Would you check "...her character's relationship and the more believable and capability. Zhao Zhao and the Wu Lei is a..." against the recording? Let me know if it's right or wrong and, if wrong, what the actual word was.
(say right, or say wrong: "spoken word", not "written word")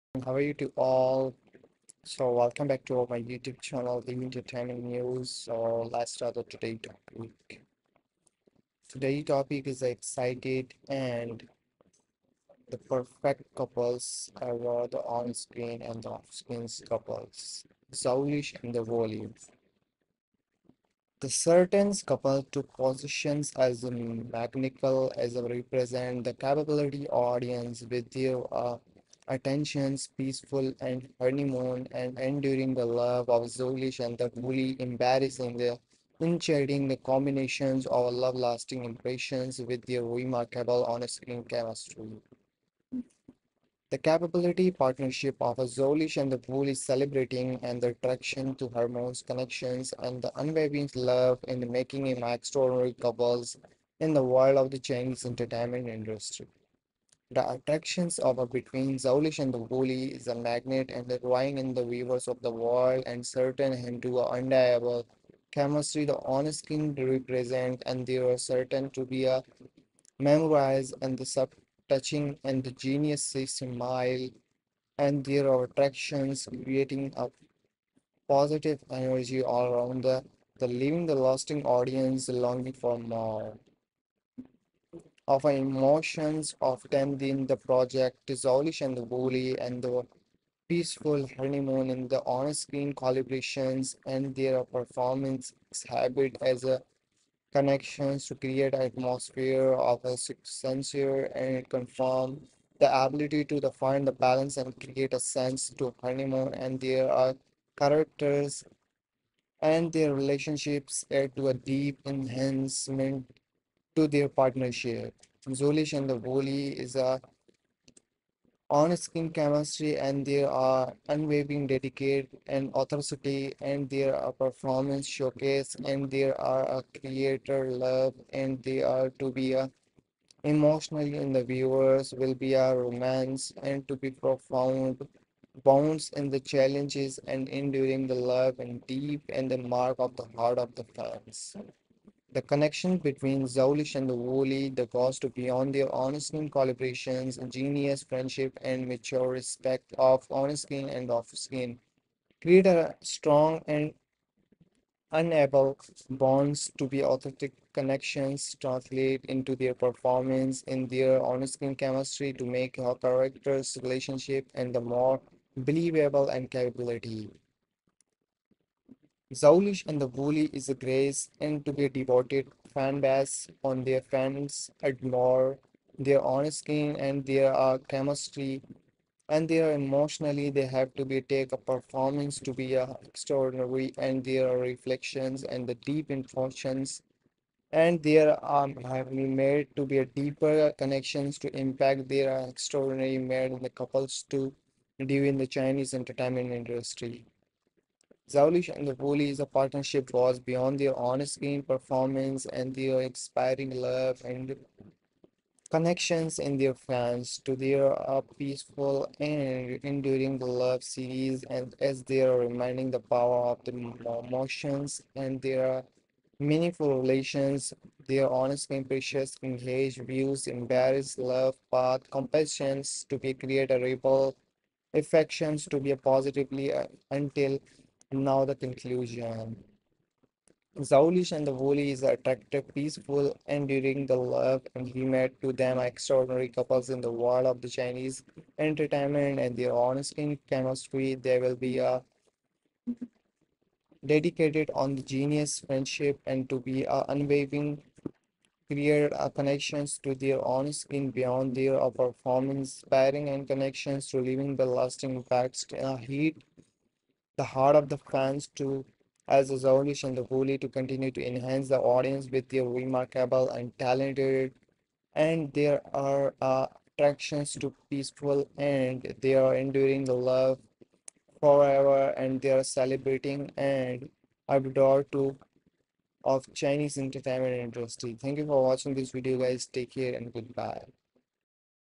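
wrong: "Lusi", not "Zhao".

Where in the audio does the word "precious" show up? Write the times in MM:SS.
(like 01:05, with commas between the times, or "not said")
03:38.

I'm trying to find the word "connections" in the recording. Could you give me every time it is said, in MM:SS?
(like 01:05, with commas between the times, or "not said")
00:49, 01:37, 02:22, 02:37, 03:10, 03:25, 04:09, 04:13.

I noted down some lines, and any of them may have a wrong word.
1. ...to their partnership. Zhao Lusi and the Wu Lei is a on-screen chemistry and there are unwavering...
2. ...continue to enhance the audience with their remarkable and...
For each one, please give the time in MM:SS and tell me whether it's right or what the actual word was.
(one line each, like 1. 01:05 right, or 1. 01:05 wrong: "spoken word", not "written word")
1. 01:53 right
2. 04:20 right.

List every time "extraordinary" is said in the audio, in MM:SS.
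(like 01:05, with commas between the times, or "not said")
00:52, 03:03, 03:12, 03:55.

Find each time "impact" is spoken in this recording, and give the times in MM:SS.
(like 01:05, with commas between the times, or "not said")
03:11, 04:15.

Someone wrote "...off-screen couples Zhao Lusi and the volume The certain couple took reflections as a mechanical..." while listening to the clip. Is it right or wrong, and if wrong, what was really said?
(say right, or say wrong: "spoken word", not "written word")
wrong: "positions", not "reflections".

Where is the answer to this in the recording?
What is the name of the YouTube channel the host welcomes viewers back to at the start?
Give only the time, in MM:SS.
00:04.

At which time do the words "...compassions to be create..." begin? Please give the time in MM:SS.
03:42.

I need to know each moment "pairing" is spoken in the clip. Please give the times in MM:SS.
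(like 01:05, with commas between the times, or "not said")
04:12.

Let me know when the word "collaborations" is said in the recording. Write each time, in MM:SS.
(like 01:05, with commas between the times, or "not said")
01:32, 02:26.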